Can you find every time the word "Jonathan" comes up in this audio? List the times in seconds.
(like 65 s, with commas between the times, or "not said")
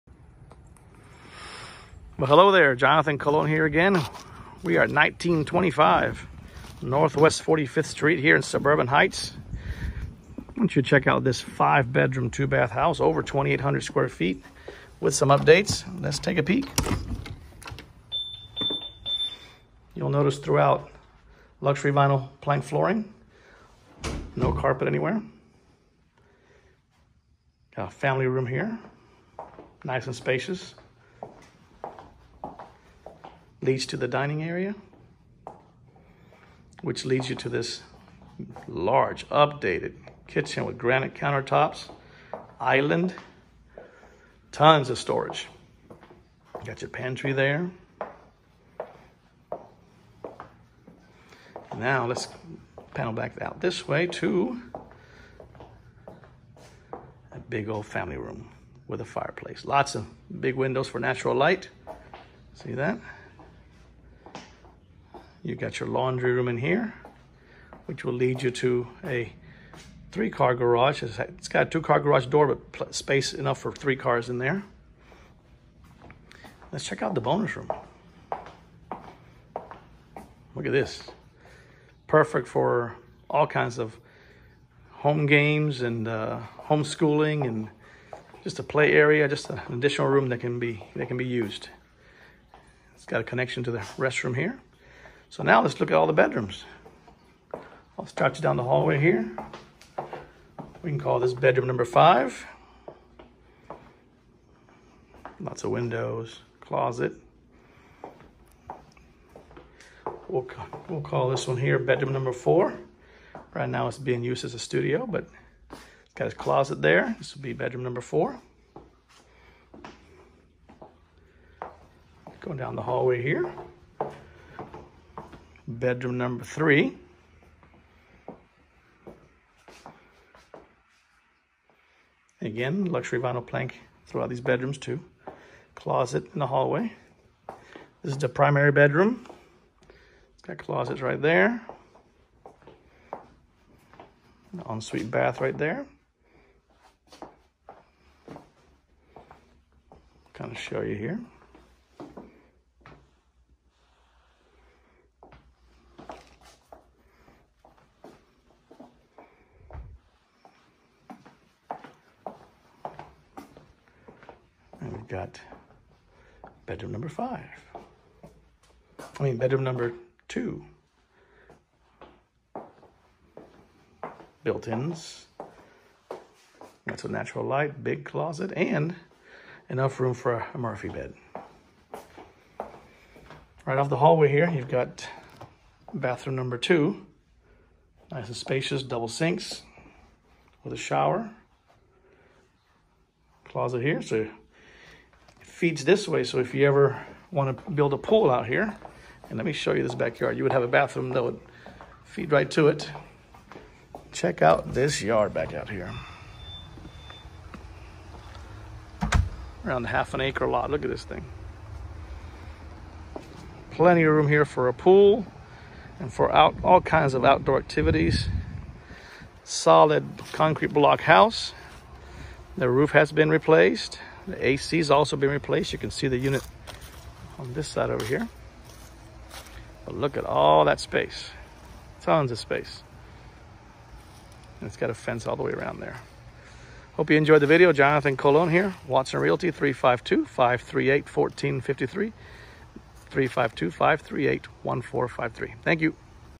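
2 s, 237 s.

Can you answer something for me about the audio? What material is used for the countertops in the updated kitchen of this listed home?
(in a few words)
Granite.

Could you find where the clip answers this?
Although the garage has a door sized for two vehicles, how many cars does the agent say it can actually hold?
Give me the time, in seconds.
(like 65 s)
70 s.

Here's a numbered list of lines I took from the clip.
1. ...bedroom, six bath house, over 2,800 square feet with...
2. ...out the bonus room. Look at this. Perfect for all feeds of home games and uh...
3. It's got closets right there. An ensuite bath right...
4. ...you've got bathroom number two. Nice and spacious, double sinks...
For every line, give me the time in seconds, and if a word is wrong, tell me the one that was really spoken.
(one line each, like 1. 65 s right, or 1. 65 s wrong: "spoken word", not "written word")
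1. 11 s wrong: "two", not "six"
2. 77 s wrong: "kinds", not "feeds"
3. 140 s right
4. 184 s right.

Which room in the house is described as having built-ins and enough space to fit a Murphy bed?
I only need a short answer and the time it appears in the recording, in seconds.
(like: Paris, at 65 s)
Bedroom number 2, at 169 s.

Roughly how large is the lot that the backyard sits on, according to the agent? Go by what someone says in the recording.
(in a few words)
Half an acre.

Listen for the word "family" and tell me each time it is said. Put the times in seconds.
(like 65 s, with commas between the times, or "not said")
27 s, 57 s.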